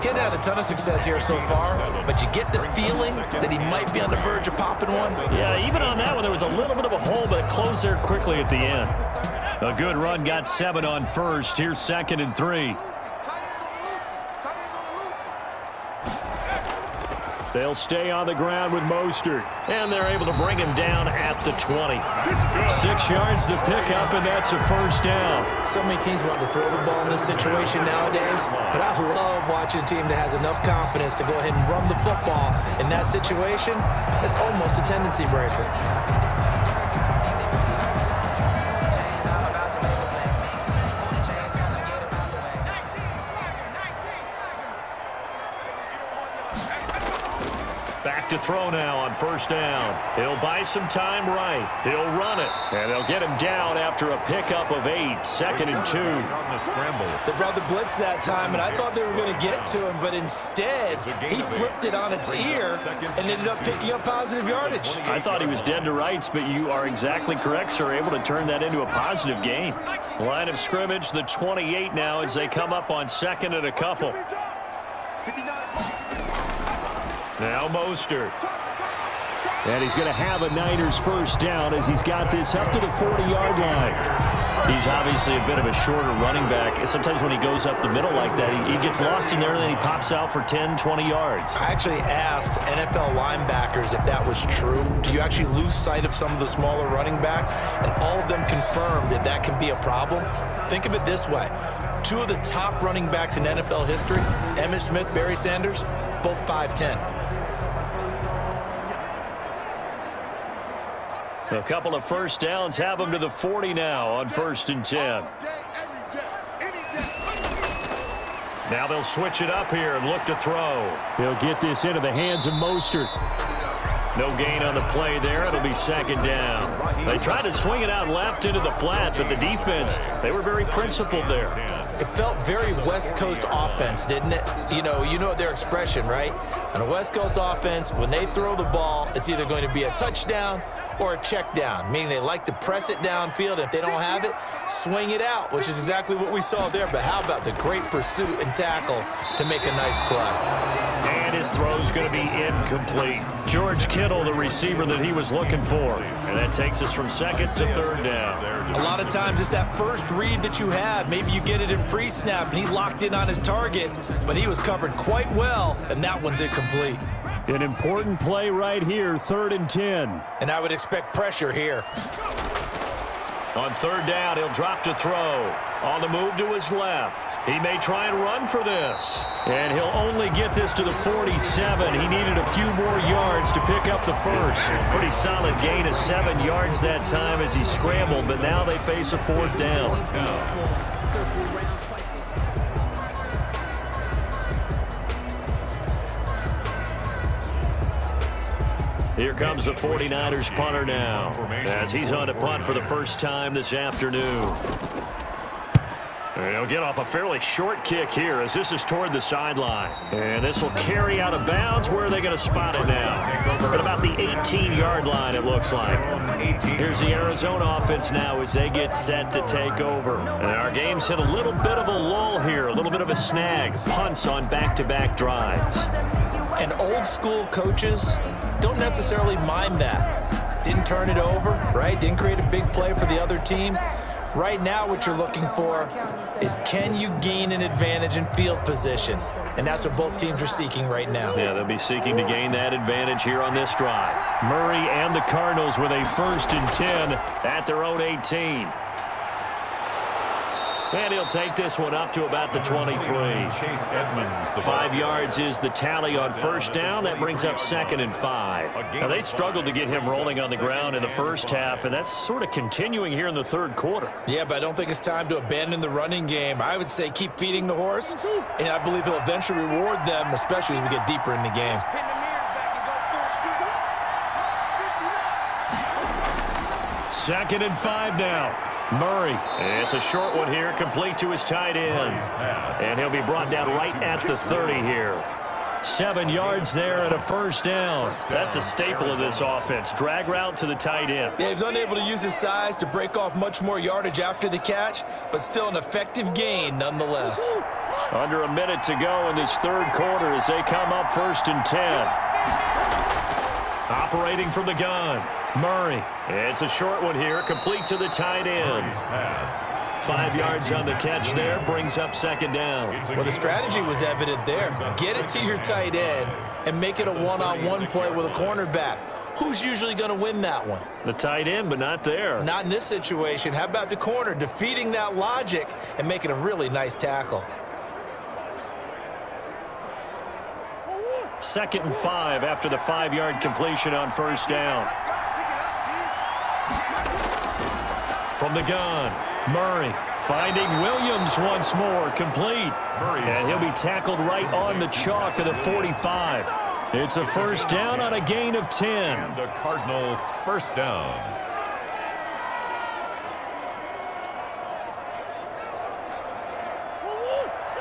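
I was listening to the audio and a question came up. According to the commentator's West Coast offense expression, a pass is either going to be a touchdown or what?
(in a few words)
a check down.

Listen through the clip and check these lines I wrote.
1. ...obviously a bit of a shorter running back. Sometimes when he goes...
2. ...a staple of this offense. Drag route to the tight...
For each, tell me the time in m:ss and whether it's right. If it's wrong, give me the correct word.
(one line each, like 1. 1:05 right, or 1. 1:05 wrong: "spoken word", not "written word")
1. 1:24 right
2. 4:48 right.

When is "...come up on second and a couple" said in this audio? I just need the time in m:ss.
1:12.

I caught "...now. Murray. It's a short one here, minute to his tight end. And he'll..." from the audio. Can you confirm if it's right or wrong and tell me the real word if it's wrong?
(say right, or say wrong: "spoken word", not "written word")
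wrong: "complete", not "minute".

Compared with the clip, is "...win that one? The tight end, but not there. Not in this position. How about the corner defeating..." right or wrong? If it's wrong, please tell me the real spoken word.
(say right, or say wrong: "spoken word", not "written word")
wrong: "situation", not "position".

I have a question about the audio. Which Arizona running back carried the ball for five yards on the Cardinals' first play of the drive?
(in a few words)
Chase Edmonds.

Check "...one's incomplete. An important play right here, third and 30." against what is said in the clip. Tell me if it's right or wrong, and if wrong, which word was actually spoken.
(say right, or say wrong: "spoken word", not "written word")
wrong: "10", not "30".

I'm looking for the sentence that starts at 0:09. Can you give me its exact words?
A good run got seven on first.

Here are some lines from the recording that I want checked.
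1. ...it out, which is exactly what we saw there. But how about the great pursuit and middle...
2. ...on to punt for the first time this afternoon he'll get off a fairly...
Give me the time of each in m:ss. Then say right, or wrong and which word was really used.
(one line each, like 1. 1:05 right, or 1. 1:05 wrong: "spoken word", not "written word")
1. 2:25 wrong: "tackle", not "middle"
2. 3:22 right.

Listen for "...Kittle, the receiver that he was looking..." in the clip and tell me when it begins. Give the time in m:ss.
2:33.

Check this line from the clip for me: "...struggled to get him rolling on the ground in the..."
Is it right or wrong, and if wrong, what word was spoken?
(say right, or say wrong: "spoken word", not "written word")
right.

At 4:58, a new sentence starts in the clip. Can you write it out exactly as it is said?
Under a minute to go in this third quarter as they come up first and 10.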